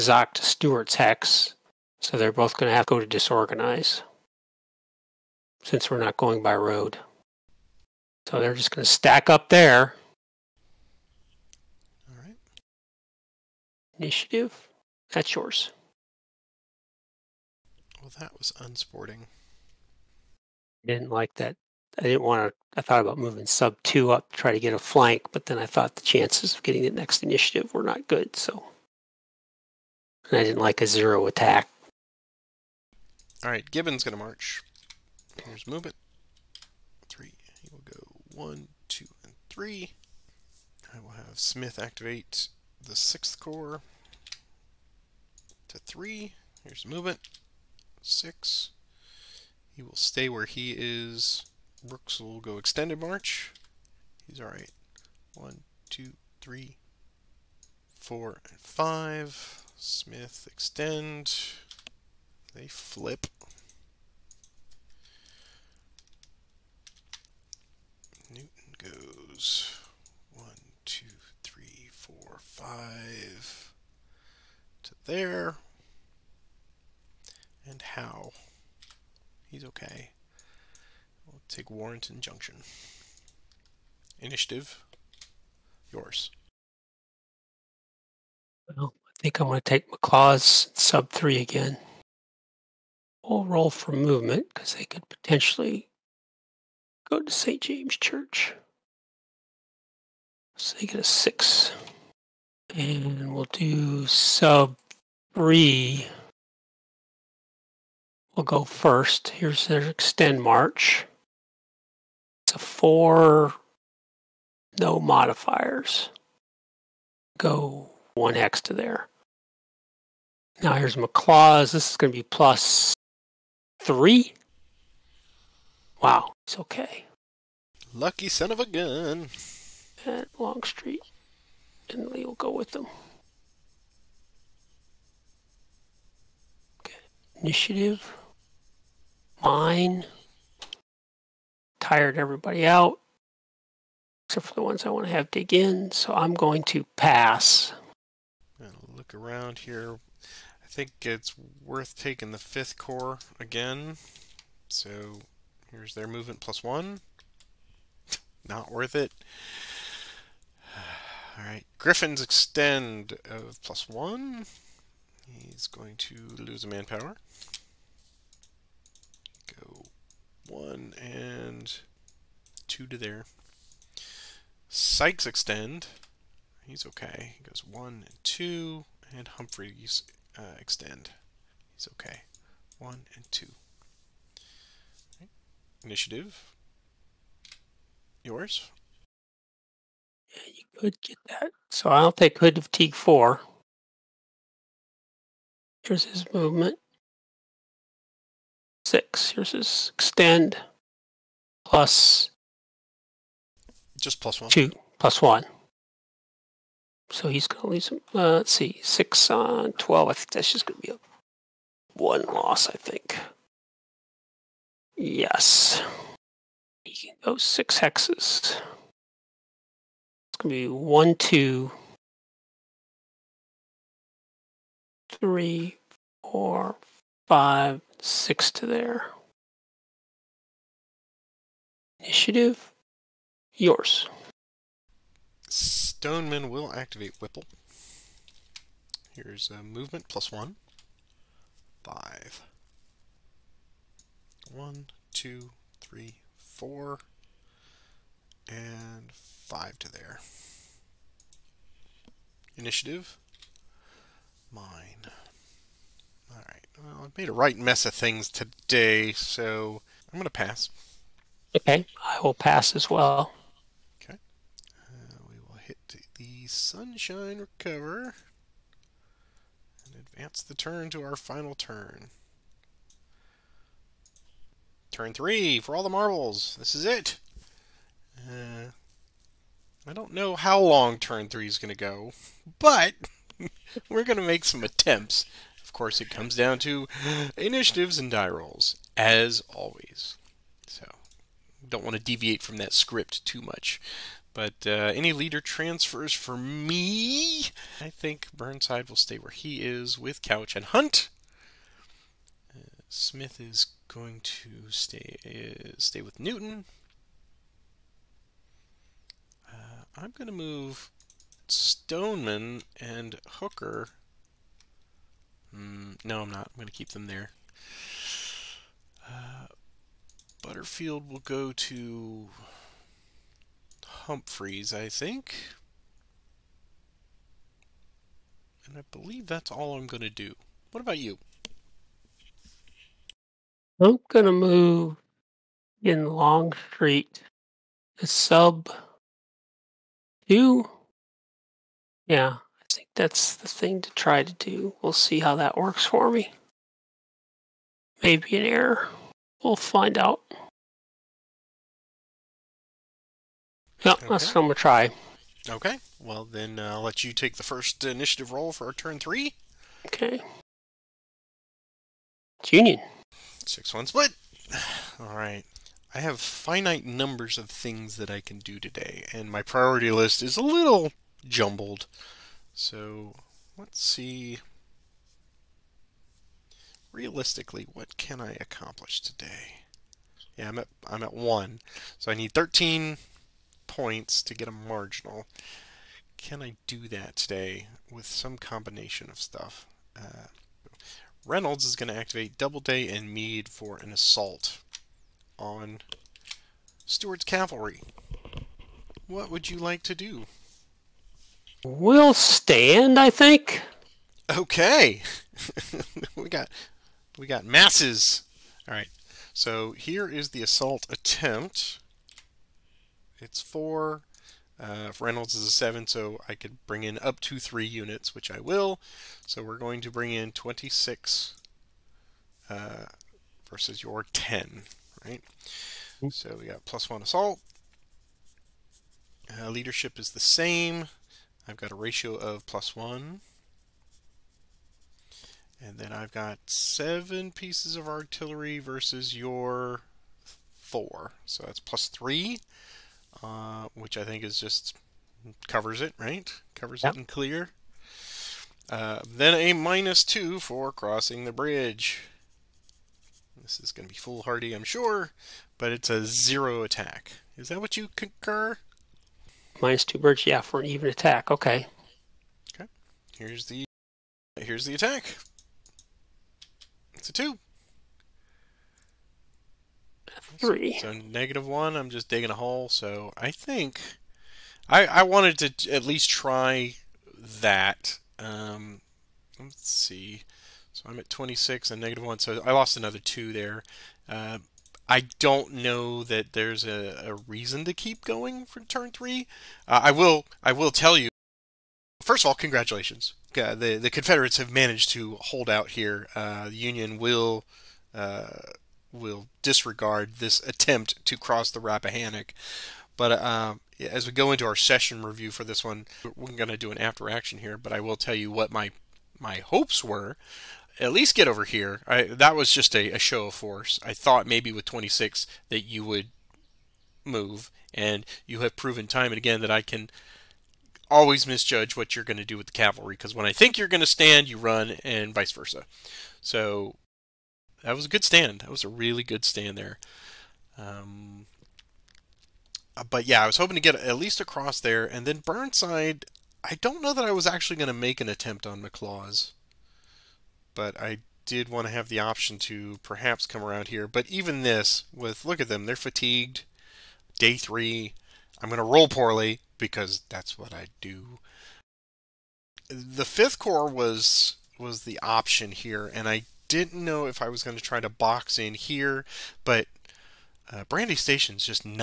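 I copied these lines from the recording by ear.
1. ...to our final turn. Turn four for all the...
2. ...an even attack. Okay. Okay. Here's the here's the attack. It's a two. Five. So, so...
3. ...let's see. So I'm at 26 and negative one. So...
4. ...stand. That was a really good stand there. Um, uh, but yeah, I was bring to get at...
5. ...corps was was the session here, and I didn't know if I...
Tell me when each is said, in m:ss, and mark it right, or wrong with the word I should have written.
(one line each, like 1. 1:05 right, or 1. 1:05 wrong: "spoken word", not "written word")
1. 4:30 wrong: "three", not "four"
2. 7:40 wrong: "Three", not "Five"
3. 7:59 right
4. 8:48 wrong: "hoping", not "bring"
5. 9:13 wrong: "option", not "session".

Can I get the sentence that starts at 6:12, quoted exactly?
So let's see realistically what can I accomplish today?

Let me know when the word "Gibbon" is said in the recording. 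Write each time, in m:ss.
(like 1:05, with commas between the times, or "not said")
0:33.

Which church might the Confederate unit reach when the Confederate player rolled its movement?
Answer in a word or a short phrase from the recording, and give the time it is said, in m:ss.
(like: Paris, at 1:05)
St. James Church, at 1:37.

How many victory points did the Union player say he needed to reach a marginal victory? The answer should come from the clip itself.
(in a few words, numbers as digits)
13.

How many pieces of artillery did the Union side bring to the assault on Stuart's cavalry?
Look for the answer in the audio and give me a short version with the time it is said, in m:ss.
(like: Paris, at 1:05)
7, at 7:16.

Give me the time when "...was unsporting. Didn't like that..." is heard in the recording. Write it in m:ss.
0:18.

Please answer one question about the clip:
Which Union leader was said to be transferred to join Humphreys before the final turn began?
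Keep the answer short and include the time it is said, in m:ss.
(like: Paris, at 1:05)
Butterfield, at 5:20.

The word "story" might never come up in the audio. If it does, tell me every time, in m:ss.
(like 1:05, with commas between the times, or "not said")
not said.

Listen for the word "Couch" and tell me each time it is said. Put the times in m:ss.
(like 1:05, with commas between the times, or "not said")
5:00.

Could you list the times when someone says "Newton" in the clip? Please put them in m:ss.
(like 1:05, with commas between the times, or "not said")
1:08, 5:06.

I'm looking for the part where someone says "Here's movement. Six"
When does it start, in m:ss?
0:46.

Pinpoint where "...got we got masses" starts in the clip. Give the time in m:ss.
6:46.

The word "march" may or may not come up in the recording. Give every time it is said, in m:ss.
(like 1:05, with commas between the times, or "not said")
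0:34, 0:53, 1:50.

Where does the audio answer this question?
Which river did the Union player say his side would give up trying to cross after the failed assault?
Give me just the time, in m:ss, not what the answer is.
8:21.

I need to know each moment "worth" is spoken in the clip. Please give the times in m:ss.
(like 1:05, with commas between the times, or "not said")
2:31, 2:38.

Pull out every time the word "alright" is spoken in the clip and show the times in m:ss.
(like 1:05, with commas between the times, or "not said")
0:54, 4:16.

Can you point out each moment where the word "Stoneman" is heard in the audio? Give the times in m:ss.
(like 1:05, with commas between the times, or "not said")
3:55, 5:11.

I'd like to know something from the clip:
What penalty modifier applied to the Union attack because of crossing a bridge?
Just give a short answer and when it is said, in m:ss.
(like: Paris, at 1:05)
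minus 2, at 7:29.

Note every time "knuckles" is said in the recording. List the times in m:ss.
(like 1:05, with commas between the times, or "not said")
not said.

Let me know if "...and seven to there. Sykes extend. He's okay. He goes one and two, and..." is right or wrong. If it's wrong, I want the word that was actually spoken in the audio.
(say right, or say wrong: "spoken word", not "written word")
wrong: "two", not "seven".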